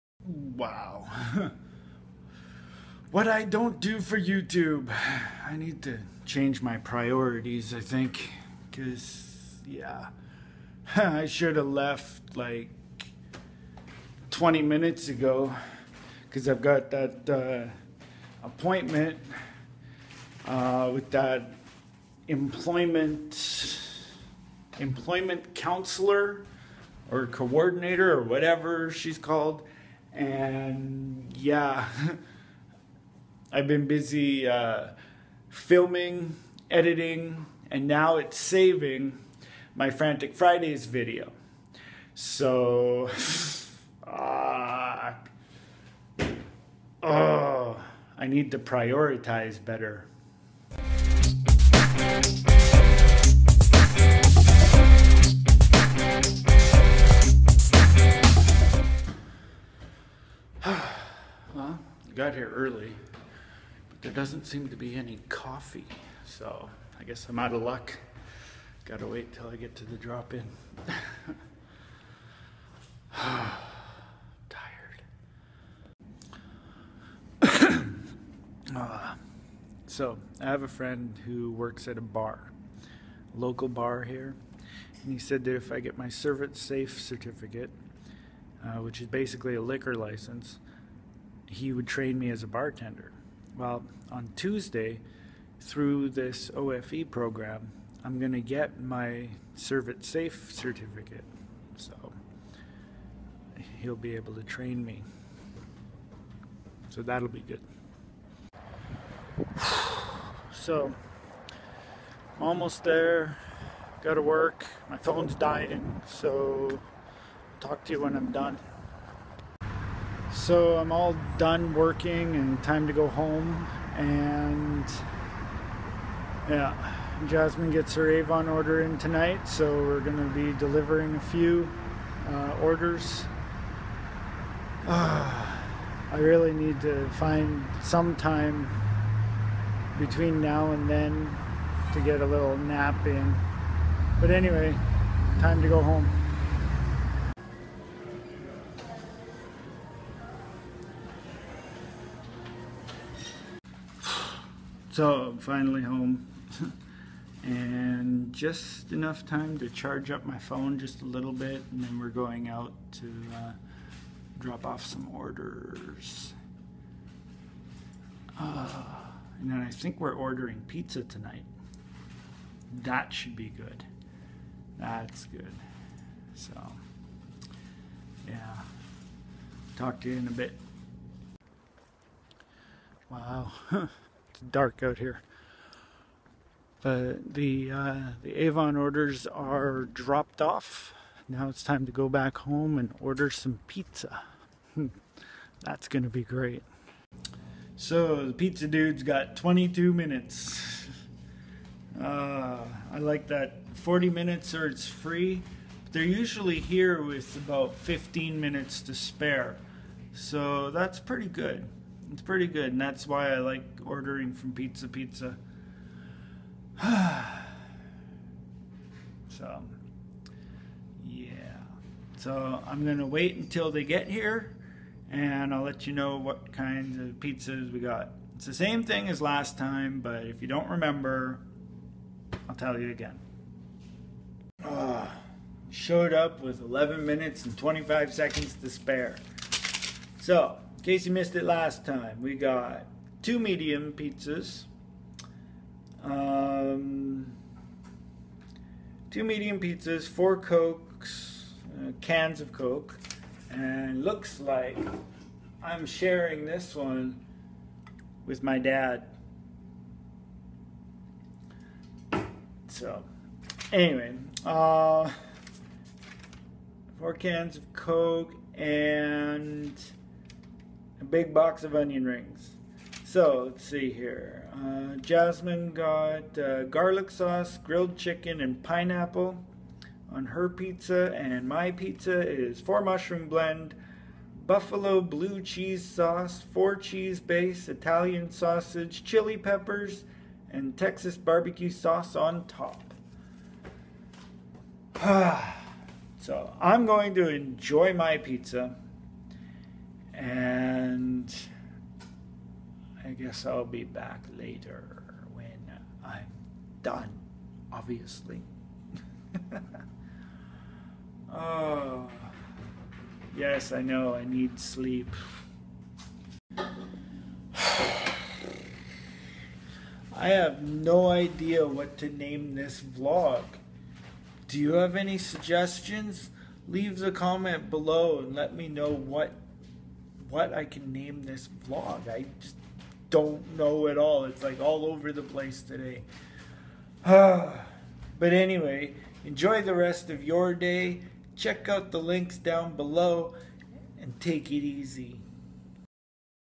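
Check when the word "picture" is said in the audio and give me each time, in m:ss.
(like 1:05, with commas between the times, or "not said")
not said.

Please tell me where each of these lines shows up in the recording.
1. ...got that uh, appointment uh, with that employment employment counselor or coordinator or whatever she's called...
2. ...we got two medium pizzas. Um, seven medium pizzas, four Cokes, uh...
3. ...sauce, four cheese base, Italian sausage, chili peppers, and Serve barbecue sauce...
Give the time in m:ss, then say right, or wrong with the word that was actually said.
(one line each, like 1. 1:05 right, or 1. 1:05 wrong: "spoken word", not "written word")
1. 0:16 right
2. 4:02 wrong: "two", not "seven"
3. 4:45 wrong: "Texas", not "Serve".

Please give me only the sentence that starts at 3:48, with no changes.
It's the same thing as last time, but if you don't remember, I'll tell you again.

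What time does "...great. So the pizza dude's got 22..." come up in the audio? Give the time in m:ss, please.
3:16.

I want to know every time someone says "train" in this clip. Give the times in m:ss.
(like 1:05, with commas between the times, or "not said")
1:31, 1:44.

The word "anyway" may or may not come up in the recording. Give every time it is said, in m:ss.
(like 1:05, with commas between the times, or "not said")
2:24, 4:23, 5:38.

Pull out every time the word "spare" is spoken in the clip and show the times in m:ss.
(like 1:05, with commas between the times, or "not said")
3:28, 3:58.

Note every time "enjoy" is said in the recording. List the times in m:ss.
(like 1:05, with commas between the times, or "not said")
4:57, 5:39.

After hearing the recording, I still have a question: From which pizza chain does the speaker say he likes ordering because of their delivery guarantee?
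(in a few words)
Pizza Pizza.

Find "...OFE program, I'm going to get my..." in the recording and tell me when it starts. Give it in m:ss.
1:36.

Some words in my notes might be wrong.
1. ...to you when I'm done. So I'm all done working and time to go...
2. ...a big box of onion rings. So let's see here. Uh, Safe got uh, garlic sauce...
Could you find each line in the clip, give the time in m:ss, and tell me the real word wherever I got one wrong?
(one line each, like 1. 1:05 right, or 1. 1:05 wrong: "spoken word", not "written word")
1. 1:57 right
2. 4:31 wrong: "Jasmen", not "Safe".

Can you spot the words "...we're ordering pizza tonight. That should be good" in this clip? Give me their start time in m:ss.
2:50.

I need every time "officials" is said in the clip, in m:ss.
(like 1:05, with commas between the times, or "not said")
not said.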